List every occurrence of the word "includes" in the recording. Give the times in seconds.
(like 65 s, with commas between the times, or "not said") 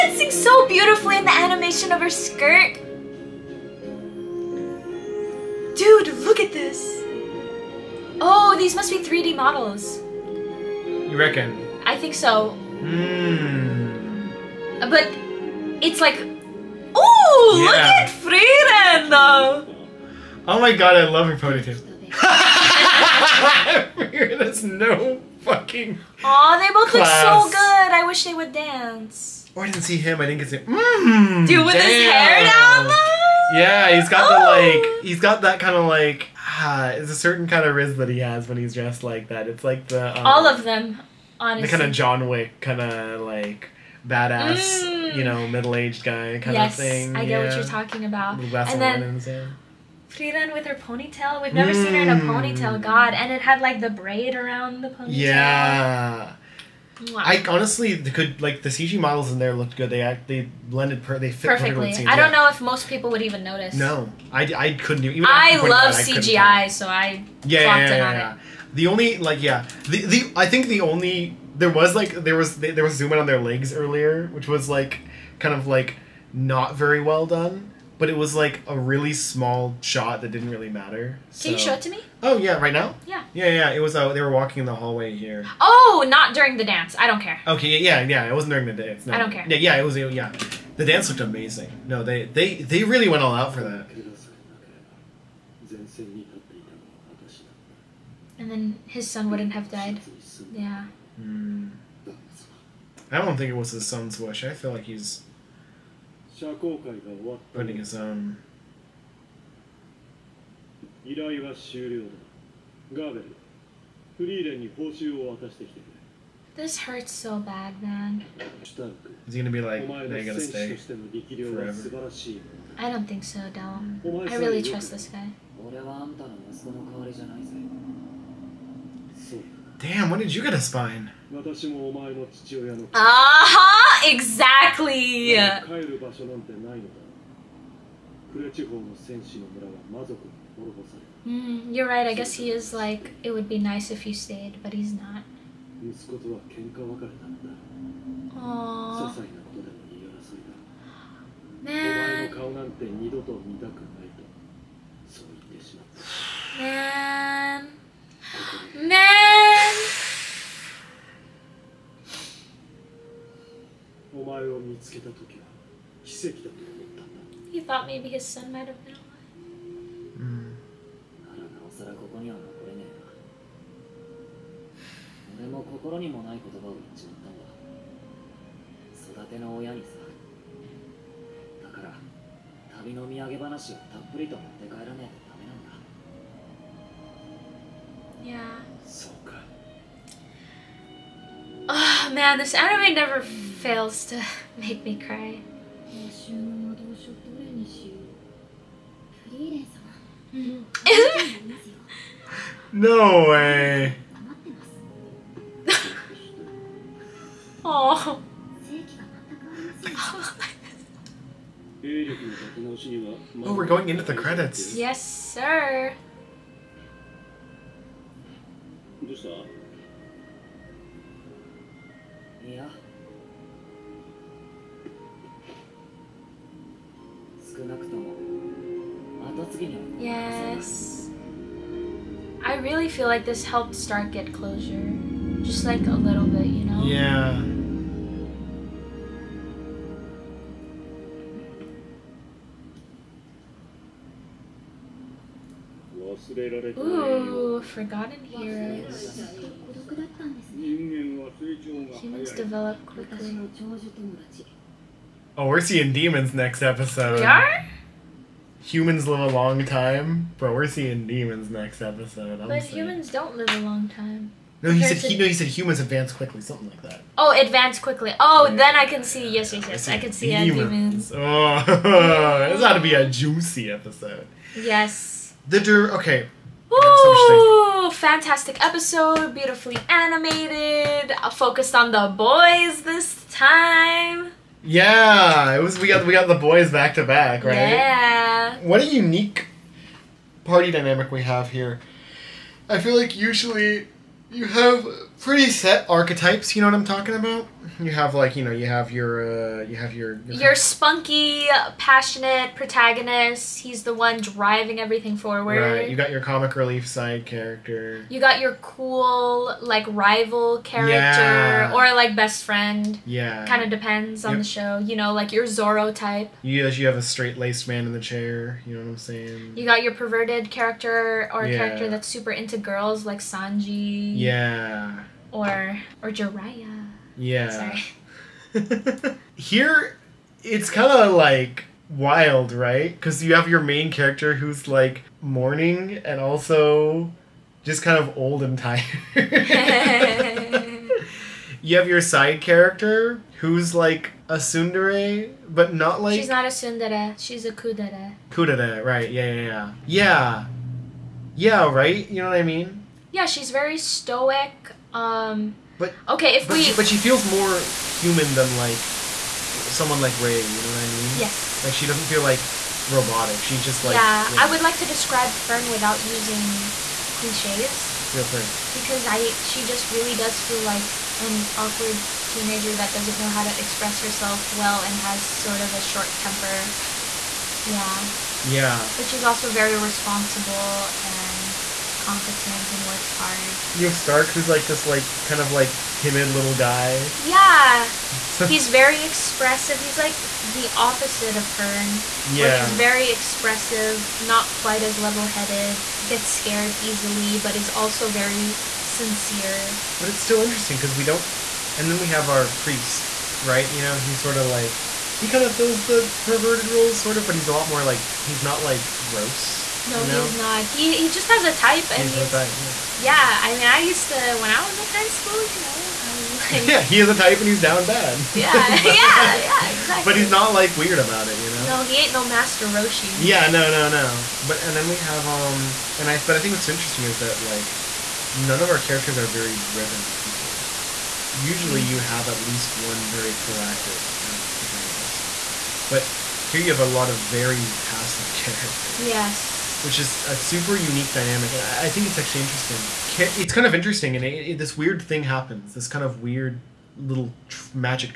not said.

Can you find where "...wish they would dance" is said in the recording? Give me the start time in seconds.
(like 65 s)
28 s.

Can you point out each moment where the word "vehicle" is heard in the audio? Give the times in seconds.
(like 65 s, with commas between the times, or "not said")
not said.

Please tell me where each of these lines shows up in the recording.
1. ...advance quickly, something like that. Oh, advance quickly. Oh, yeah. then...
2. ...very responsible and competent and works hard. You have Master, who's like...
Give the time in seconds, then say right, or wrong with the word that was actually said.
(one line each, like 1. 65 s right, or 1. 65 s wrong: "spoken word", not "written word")
1. 265 s right
2. 379 s wrong: "Stark", not "Master".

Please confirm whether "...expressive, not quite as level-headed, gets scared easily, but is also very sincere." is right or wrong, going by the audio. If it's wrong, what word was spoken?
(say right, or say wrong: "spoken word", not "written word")
right.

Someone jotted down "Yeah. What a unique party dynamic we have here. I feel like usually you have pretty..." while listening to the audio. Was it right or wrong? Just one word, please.
right.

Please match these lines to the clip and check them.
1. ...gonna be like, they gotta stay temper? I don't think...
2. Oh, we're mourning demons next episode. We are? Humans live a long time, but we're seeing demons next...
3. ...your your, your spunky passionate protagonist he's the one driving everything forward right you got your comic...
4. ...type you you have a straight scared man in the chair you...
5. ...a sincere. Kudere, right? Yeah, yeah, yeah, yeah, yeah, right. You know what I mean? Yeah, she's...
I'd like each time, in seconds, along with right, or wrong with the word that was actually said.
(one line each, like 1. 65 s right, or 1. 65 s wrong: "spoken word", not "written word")
1. 119 s wrong: "forever", not "temper"
2. 255 s wrong: "seeing", not "mourning"
3. 299 s right
4. 315 s wrong: "laced", not "scared"
5. 347 s wrong: "kudere", not "sincere".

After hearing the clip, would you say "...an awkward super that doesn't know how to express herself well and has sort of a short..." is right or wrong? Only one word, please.
wrong.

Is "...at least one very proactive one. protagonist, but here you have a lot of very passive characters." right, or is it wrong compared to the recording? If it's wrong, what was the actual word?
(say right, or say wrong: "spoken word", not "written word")
right.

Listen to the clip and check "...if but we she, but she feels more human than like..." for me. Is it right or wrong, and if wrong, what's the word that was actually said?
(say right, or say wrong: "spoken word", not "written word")
right.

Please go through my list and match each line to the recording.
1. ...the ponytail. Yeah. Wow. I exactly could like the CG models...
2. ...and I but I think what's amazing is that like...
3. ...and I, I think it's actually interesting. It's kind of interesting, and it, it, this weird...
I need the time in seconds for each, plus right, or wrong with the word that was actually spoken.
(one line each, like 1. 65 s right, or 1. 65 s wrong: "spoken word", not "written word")
1. 54 s wrong: "honestly", not "exactly"
2. 425 s wrong: "interesting", not "amazing"
3. 441 s right.